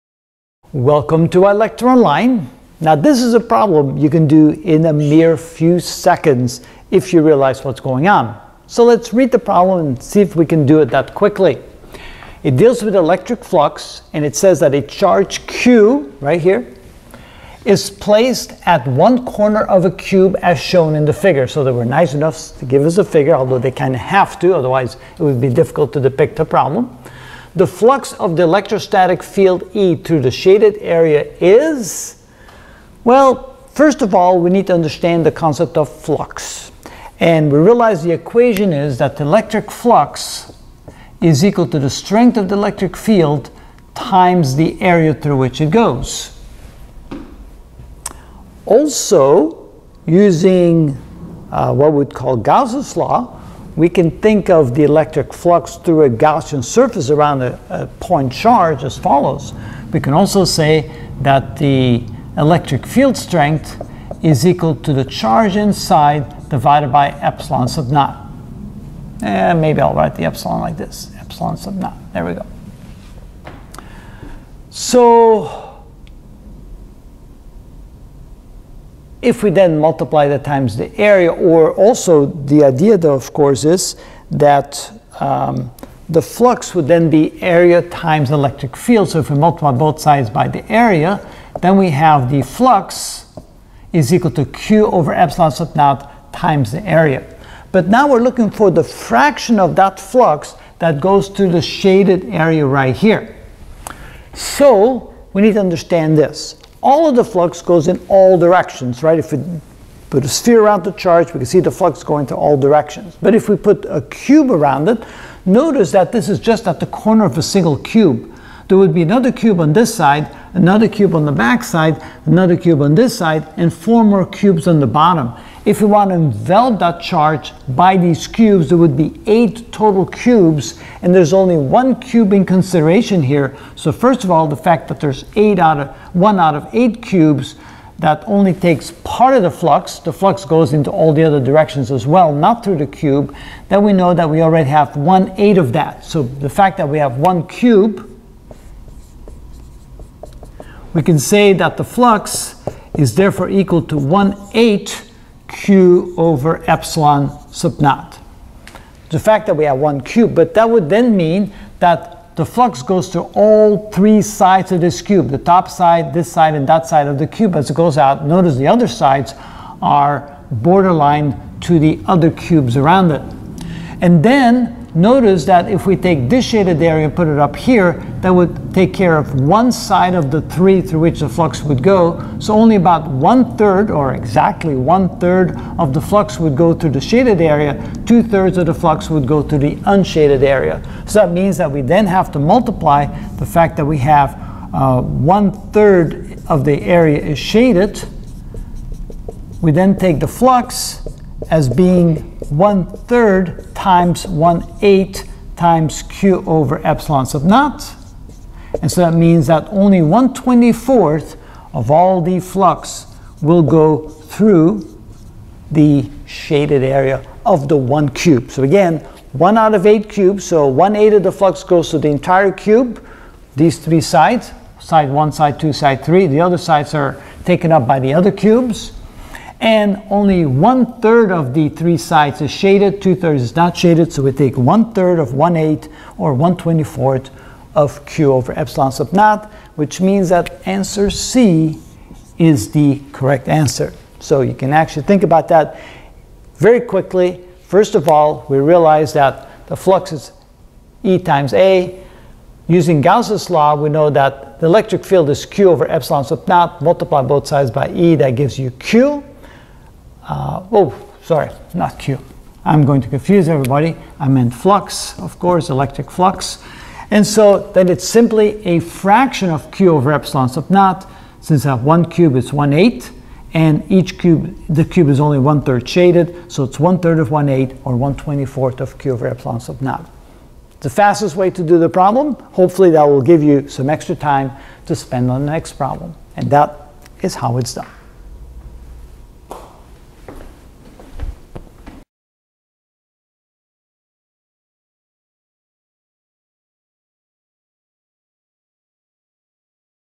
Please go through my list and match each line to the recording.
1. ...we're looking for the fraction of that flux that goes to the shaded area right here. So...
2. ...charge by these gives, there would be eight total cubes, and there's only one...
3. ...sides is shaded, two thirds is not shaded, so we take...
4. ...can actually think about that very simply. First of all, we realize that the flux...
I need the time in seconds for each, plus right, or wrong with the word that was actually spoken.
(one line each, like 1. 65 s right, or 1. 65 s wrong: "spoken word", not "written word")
1. 98 s right
2. 127 s wrong: "cubes", not "gives"
3. 231 s right
4. 244 s wrong: "quickly", not "simply".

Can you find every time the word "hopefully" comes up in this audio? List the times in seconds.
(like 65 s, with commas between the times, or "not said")
282 s.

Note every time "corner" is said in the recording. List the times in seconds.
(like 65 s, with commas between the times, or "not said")
19 s, 116 s.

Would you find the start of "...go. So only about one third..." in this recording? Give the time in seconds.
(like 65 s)
181 s.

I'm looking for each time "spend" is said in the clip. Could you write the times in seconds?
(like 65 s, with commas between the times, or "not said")
284 s.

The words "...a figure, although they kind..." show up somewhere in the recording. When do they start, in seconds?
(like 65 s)
22 s.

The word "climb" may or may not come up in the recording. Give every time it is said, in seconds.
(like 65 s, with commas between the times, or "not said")
not said.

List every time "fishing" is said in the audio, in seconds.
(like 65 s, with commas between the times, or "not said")
not said.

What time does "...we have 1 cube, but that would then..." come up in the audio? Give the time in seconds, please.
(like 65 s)
159 s.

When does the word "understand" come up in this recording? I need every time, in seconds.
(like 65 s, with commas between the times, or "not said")
34 s, 105 s.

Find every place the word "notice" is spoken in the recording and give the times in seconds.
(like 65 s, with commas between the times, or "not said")
115 s, 168 s, 174 s.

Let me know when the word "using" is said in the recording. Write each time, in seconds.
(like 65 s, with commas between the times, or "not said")
50 s, 252 s.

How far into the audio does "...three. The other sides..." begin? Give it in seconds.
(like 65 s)
226 s.